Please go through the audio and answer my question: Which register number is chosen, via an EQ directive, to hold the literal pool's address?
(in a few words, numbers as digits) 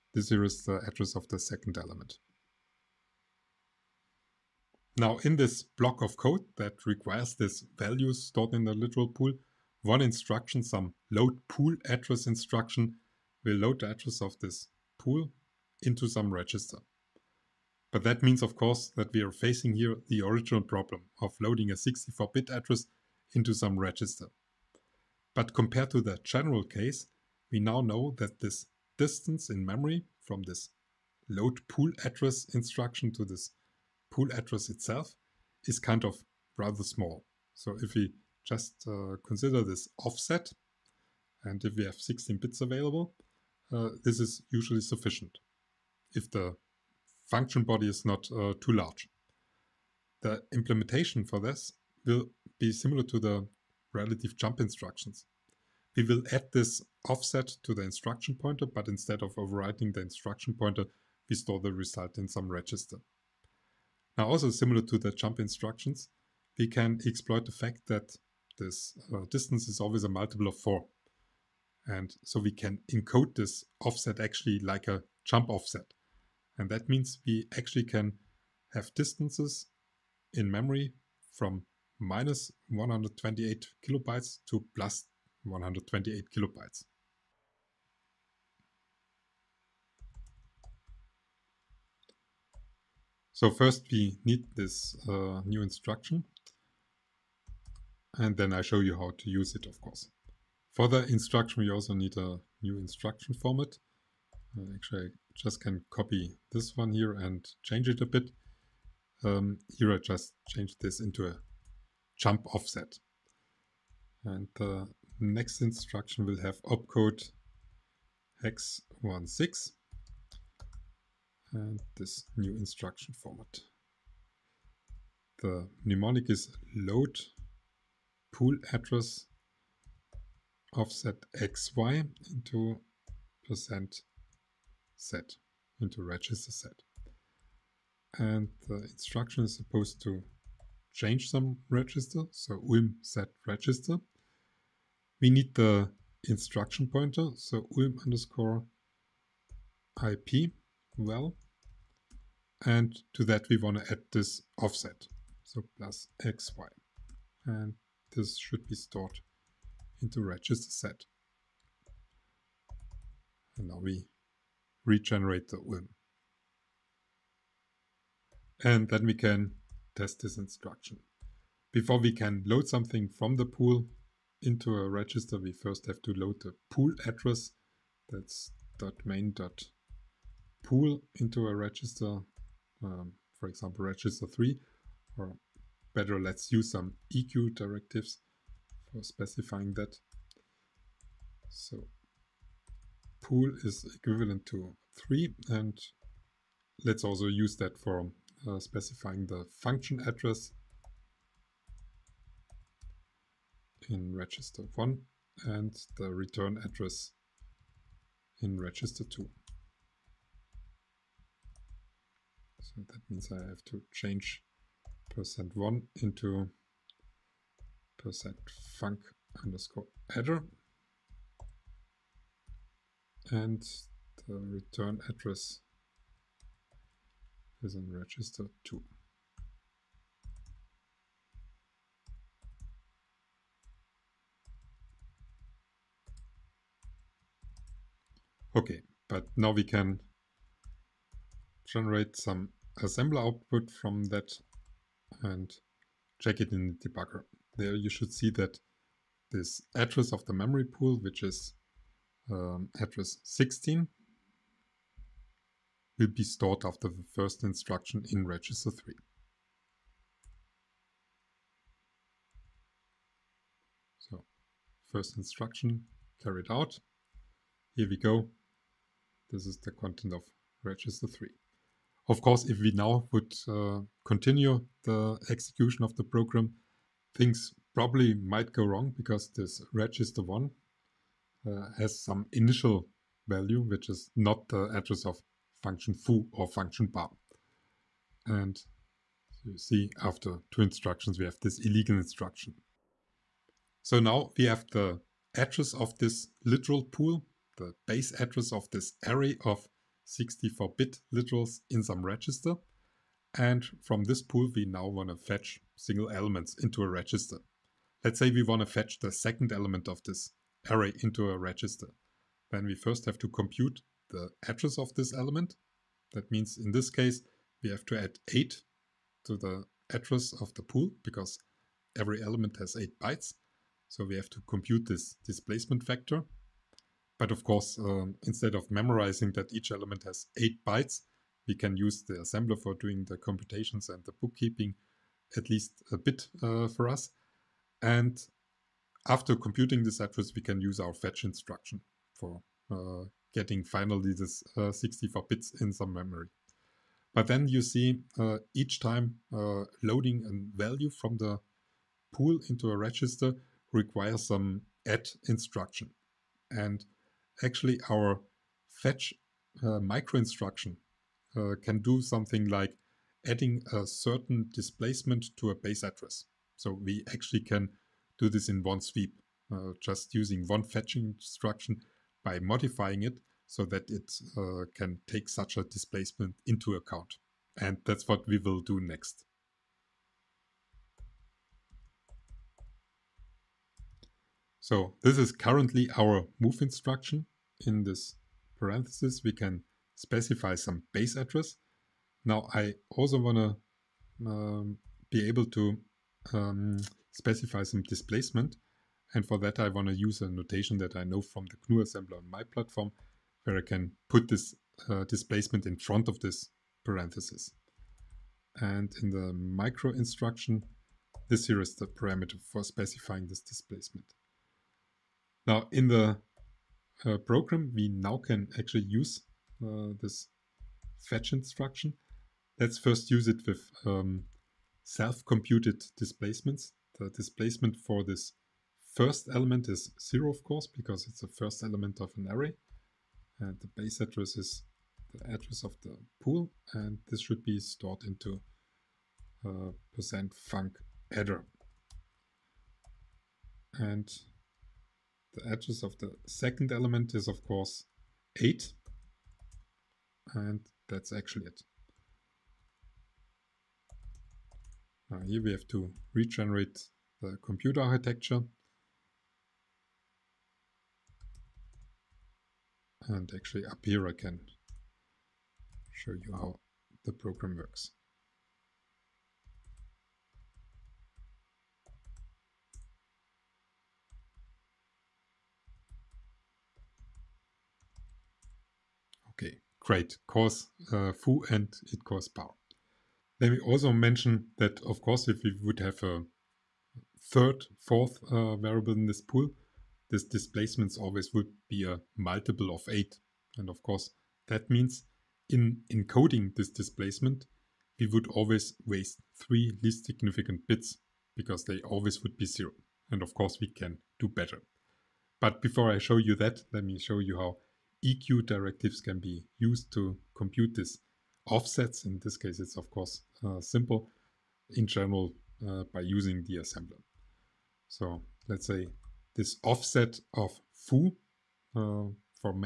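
3.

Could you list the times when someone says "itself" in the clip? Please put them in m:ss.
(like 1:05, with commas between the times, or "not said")
0:34.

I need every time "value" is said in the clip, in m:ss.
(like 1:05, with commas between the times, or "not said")
0:07, 4:43, 5:50.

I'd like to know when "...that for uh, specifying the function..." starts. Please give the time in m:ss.
3:17.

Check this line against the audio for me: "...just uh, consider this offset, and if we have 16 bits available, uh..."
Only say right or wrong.
right.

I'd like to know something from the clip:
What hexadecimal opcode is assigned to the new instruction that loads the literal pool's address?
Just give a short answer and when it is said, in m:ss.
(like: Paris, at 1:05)
hex 16, at 1:58.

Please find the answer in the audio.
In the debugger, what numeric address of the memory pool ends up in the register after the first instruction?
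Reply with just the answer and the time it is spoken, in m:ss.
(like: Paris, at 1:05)
16, at 4:12.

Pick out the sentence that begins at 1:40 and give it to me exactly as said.
For the instruction, we also need a new instruction format.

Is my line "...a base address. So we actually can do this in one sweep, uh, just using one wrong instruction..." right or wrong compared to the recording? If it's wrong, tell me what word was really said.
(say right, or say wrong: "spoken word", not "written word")
wrong: "fetching", not "wrong".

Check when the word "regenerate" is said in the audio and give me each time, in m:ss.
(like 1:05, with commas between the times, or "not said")
2:44, 7:36.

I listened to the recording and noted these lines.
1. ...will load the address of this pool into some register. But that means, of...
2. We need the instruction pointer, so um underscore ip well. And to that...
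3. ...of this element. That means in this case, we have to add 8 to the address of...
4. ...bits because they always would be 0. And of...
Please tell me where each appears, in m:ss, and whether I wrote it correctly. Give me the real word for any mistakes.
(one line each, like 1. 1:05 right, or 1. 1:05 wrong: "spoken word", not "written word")
1. 0:13 right
2. 2:25 right
3. 5:14 right
4. 8:20 right.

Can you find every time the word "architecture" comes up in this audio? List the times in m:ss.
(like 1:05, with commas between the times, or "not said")
7:37.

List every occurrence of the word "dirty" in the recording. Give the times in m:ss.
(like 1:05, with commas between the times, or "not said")
not said.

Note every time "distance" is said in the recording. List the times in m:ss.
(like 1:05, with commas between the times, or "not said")
0:28, 1:09, 1:18.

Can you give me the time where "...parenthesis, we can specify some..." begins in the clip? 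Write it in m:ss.
6:28.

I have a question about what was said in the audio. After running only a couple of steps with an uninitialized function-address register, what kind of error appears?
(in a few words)
illegal instruction.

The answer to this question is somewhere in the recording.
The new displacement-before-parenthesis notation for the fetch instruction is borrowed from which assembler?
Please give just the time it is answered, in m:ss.
6:41.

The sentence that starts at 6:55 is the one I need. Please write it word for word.
Now in the uh, program, we now can actually use uh, this fetch instruction.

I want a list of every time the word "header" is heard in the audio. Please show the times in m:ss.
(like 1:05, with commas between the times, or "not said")
3:40, 7:21.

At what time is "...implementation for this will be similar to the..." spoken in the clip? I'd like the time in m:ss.
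0:50.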